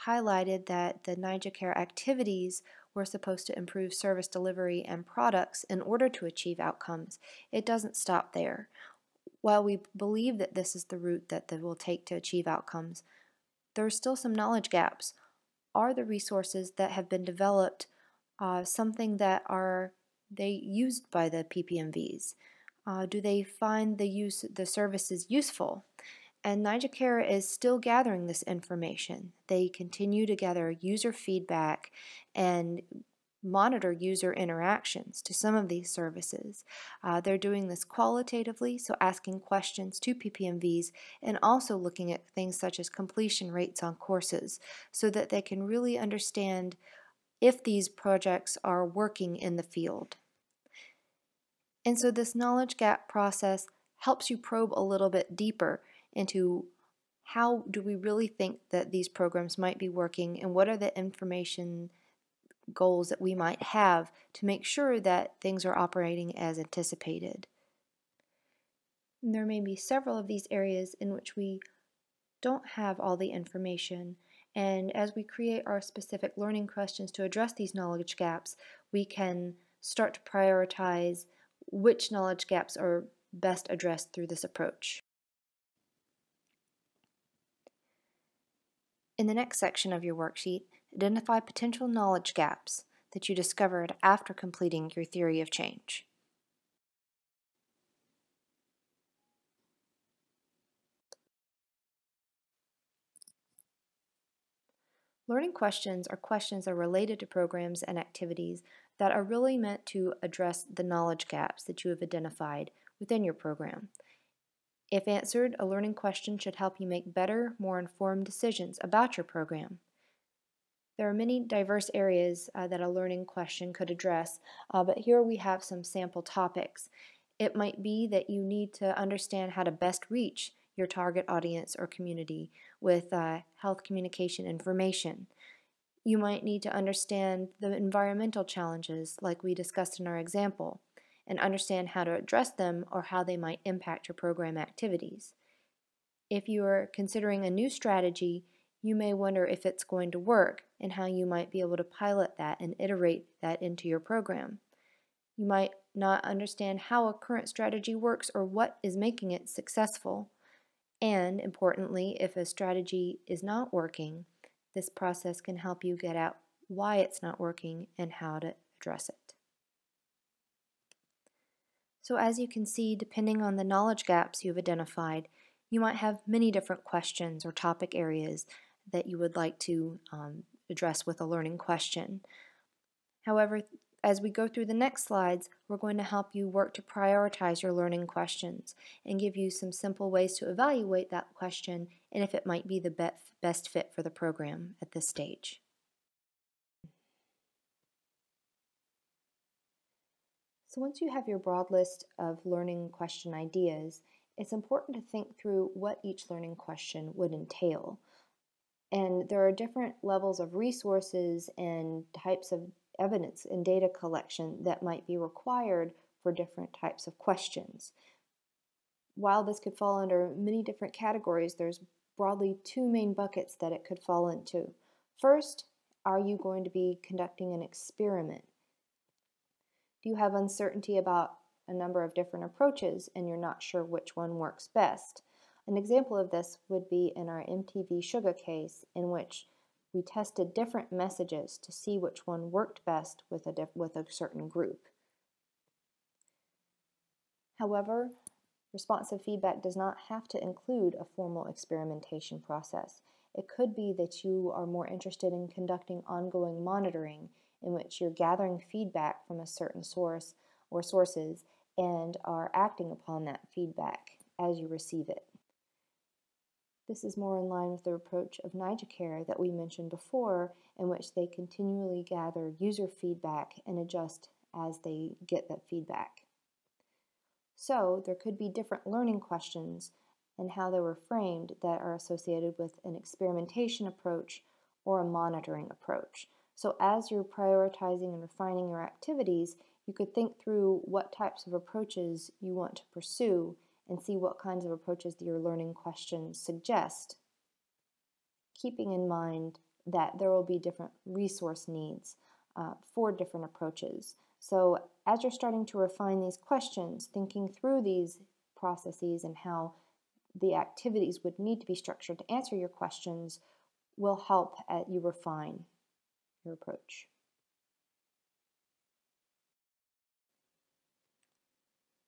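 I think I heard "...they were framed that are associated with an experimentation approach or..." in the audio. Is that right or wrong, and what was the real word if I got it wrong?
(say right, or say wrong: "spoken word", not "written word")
right.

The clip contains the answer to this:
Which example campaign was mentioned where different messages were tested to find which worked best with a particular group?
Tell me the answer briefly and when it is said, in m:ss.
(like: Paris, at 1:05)
MTV Shuga, at 3:57.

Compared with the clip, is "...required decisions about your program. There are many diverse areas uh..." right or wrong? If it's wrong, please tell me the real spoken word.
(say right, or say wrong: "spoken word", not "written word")
wrong: "informed", not "required".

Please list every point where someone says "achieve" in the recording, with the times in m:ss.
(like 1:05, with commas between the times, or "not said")
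0:06, 0:12.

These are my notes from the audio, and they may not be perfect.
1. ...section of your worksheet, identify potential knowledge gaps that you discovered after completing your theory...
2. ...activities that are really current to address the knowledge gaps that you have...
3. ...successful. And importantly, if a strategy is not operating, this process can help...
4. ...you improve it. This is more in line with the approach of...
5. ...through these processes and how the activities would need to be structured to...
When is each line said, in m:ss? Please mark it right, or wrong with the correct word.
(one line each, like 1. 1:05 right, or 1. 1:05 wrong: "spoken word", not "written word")
1. 1:29 right
2. 1:47 wrong: "meant", not "current"
3. 2:39 wrong: "working", not "operating"
4. 4:24 wrong: "receive", not "improve"
5. 5:07 right.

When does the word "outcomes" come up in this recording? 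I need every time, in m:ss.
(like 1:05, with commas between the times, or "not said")
0:06, 0:12.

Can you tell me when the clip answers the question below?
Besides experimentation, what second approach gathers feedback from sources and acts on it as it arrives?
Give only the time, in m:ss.
4:16.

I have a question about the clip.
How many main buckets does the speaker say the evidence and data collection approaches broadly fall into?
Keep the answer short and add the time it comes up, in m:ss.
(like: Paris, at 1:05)
2, at 3:42.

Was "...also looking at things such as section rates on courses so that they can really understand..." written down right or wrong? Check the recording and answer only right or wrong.
wrong.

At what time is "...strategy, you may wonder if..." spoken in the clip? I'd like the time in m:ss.
2:27.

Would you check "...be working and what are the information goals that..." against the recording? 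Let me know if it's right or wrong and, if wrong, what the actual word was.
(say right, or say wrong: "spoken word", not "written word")
right.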